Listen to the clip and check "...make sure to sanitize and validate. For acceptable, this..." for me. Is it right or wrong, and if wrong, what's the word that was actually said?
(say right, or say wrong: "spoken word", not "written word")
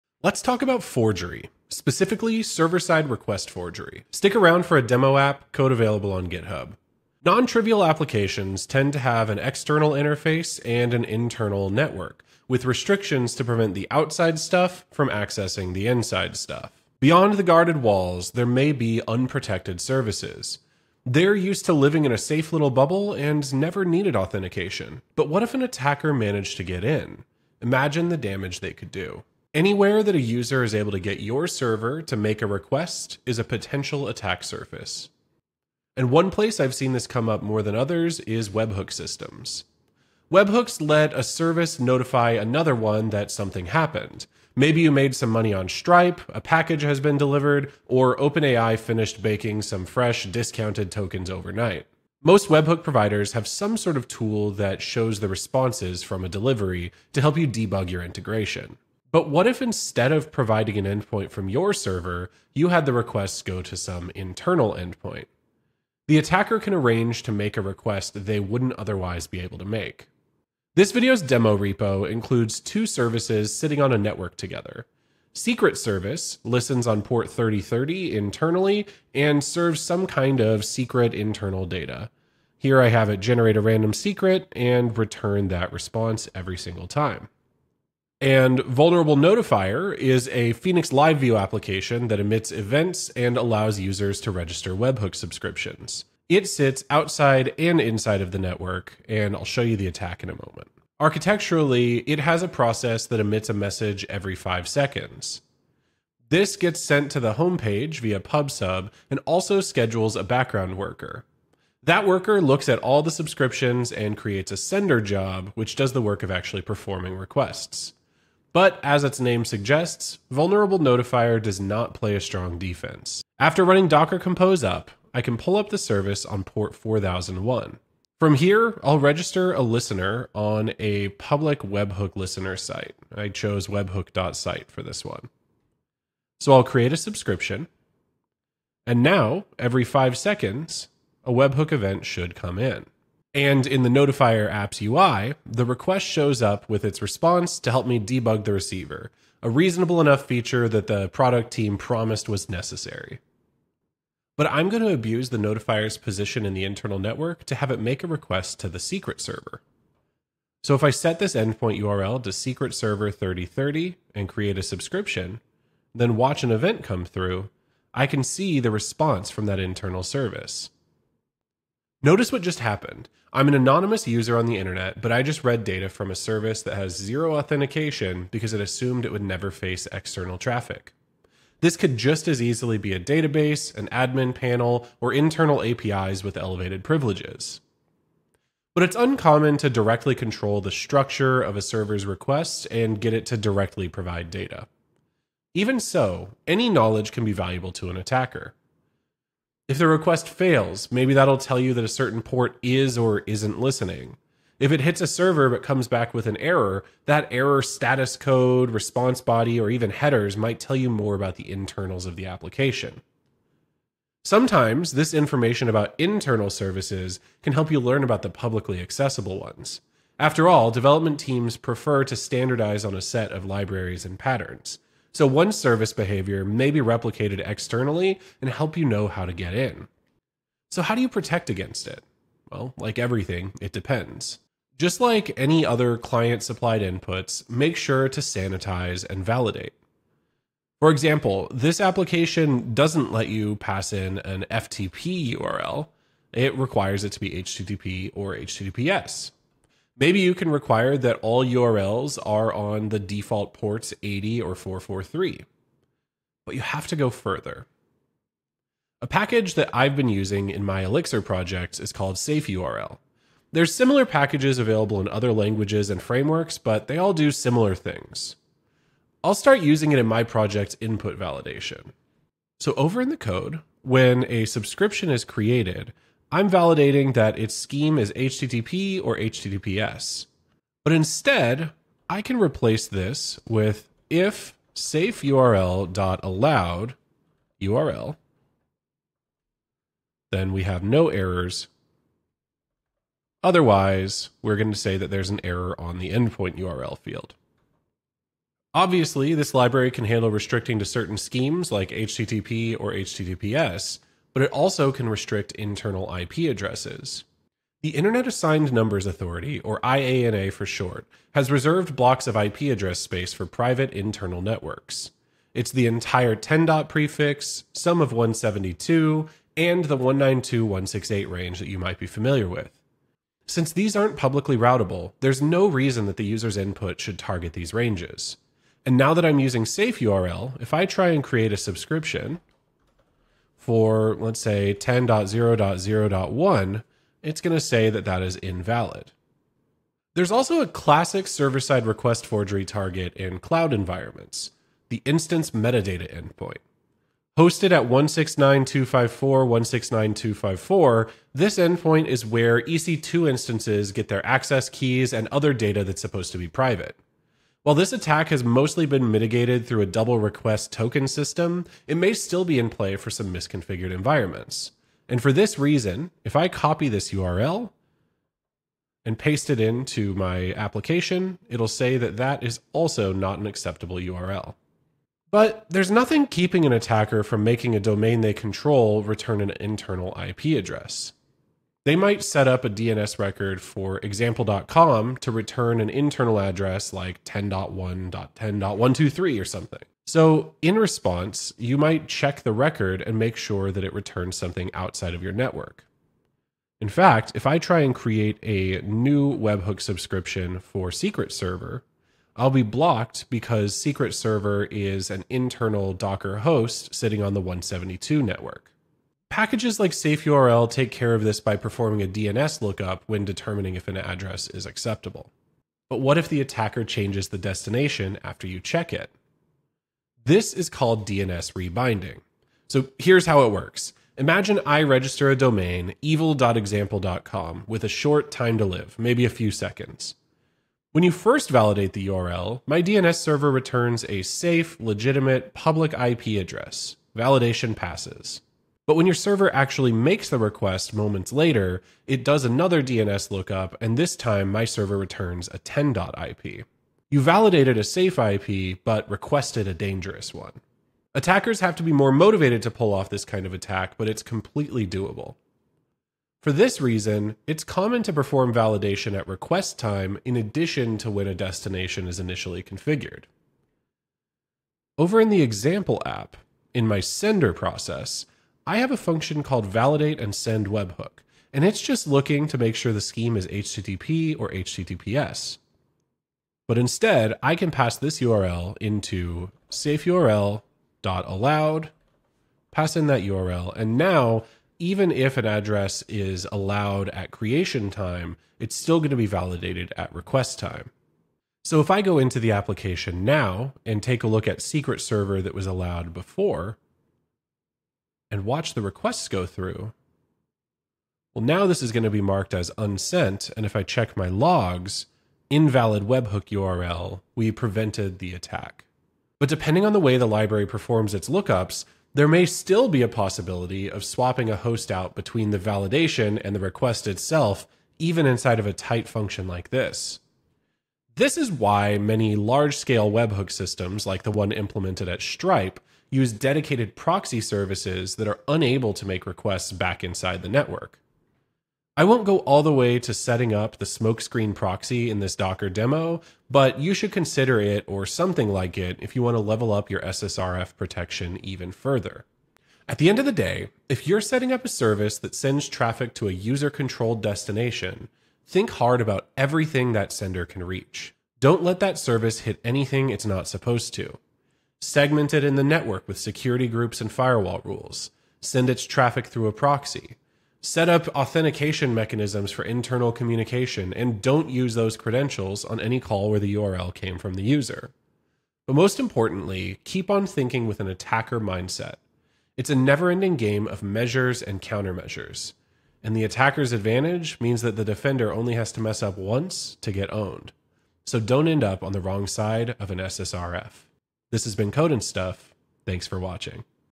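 wrong: "example", not "acceptable".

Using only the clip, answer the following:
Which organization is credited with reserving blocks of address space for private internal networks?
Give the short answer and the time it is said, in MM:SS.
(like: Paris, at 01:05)
Internet Assigned Numbers Authority, at 05:07.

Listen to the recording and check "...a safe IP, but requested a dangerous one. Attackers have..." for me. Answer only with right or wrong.
right.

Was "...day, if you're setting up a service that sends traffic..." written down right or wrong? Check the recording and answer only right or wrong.
right.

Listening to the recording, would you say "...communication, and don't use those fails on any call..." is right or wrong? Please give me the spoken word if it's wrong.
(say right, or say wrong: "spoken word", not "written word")
wrong: "credentials", not "fails".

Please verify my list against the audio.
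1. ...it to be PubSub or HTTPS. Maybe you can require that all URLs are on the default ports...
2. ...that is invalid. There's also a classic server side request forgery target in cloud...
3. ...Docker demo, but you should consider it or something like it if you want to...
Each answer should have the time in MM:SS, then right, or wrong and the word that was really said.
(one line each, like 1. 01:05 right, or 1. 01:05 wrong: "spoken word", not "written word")
1. 04:07 wrong: "HTTP", not "PubSub"
2. 05:38 right
3. 08:55 right.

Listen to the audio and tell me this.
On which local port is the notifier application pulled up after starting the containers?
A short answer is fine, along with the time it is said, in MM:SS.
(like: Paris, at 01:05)
4001, at 02:06.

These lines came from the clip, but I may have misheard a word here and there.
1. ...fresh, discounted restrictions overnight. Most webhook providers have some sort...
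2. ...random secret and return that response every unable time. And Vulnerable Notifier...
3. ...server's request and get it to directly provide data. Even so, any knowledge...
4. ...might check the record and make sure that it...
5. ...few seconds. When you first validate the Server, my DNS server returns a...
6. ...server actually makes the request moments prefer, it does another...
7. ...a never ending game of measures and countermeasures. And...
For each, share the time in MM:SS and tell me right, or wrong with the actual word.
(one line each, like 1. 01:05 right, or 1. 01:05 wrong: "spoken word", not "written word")
1. 00:49 wrong: "tokens", not "restrictions"
2. 01:23 wrong: "single", not "unable"
3. 03:11 right
4. 06:31 right
5. 07:09 wrong: "URL", not "Server"
6. 07:19 wrong: "later", not "prefer"
7. 09:32 right.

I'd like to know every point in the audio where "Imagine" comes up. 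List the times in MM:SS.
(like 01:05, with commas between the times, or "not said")
00:27, 07:04.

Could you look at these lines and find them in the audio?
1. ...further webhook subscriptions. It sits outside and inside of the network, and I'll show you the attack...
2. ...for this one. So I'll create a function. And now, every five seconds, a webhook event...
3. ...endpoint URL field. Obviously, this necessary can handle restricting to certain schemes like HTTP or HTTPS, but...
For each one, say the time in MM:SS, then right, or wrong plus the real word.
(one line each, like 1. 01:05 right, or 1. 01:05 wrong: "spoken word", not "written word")
1. 01:34 wrong: "register", not "further"
2. 02:14 wrong: "subscription", not "function"
3. 04:56 wrong: "library", not "necessary".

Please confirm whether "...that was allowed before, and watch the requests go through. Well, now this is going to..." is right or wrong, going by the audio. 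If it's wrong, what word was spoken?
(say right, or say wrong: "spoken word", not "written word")
right.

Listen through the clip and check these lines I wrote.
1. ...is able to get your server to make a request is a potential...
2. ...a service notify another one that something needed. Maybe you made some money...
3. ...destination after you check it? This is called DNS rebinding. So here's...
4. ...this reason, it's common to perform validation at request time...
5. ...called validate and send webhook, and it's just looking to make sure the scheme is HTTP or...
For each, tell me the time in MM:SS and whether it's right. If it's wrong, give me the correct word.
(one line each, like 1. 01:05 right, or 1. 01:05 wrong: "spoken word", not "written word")
1. 00:30 right
2. 00:41 wrong: "happened", not "needed"
3. 06:57 right
4. 07:36 right
5. 07:49 right.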